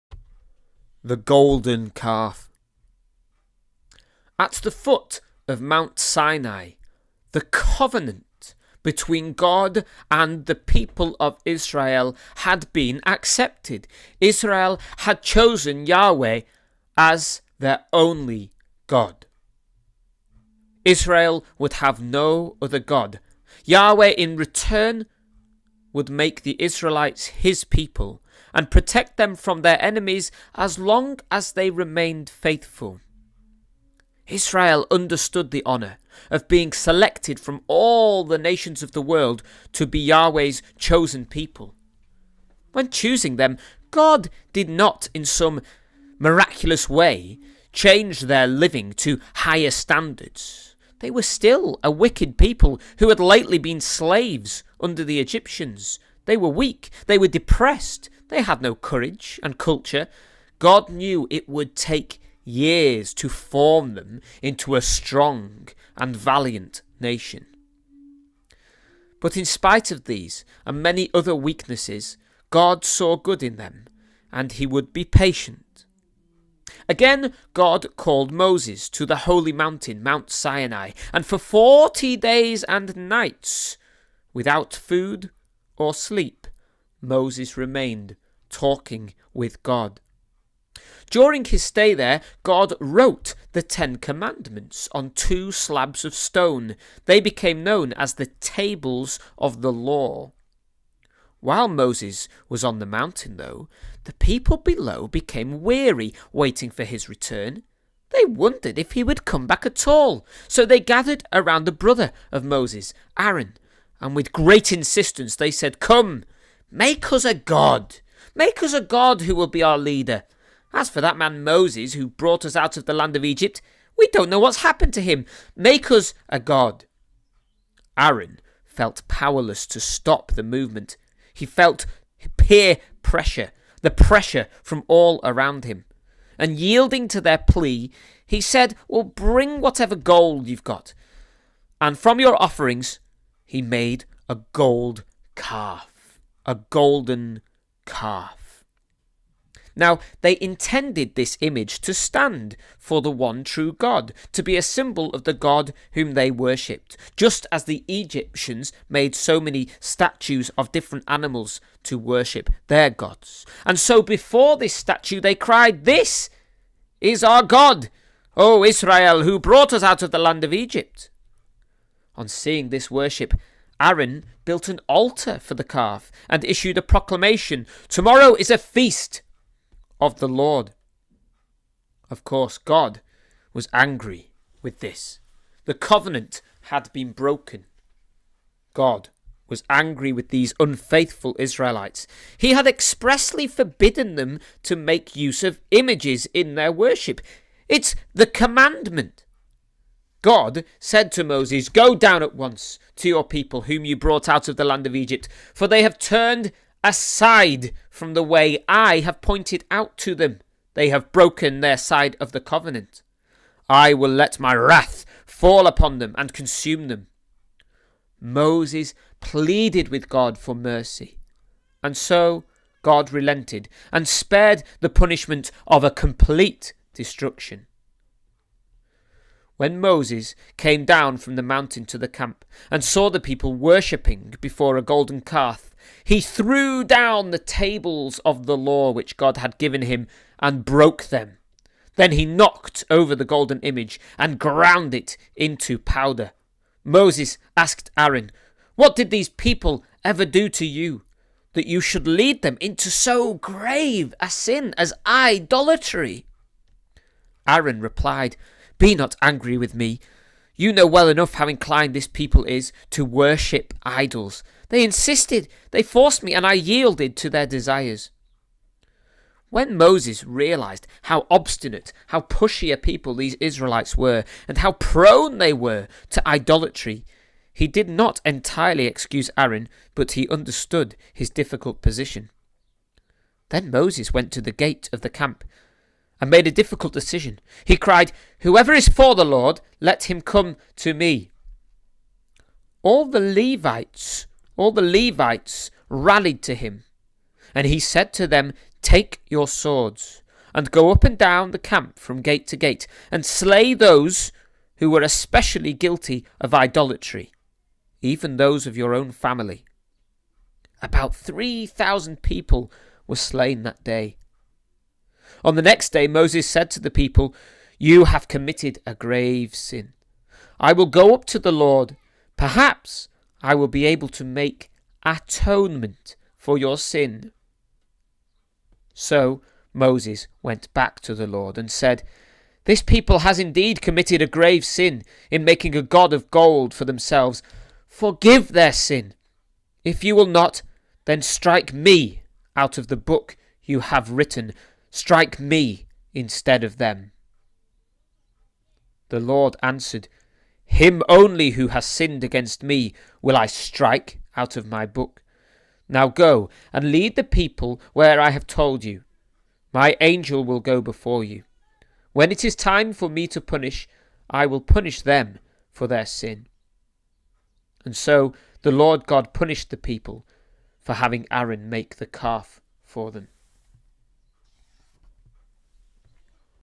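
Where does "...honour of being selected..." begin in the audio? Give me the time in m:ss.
0:35.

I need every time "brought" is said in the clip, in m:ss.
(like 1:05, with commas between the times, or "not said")
2:02, 2:49, 3:23.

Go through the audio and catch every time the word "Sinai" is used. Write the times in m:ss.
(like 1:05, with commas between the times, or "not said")
0:05, 1:20.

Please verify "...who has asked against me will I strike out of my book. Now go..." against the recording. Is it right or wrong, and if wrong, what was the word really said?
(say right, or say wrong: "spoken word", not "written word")
wrong: "sinned", not "asked".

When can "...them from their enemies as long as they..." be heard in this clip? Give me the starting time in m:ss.
0:29.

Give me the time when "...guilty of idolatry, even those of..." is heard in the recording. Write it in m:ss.
5:05.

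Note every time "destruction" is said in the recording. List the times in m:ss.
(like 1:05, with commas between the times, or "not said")
3:46.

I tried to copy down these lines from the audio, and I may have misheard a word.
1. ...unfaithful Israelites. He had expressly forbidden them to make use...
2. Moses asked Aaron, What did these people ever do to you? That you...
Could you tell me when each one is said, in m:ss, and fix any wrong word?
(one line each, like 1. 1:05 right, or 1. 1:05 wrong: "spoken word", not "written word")
1. 3:10 right
2. 4:06 right.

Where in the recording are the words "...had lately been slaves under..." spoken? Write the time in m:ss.
0:53.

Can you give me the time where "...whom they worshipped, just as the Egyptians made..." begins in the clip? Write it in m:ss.
2:35.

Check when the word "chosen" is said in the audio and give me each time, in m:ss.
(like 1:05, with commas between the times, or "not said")
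0:15, 0:40.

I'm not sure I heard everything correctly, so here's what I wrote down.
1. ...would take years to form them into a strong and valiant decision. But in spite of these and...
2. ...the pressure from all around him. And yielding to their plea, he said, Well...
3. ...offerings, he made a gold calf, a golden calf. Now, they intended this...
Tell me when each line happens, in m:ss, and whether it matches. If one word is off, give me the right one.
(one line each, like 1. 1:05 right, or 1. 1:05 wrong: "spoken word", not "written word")
1. 1:01 wrong: "nation", not "decision"
2. 2:13 right
3. 2:22 right.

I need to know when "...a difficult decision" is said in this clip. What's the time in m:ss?
4:46.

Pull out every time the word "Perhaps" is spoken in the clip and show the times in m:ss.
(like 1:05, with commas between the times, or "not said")
5:22.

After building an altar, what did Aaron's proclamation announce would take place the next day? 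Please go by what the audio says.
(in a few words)
A feast of the Lord.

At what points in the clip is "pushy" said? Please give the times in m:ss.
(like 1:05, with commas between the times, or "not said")
4:32.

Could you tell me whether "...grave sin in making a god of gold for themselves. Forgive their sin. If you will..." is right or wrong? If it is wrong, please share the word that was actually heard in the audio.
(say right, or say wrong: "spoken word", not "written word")
right.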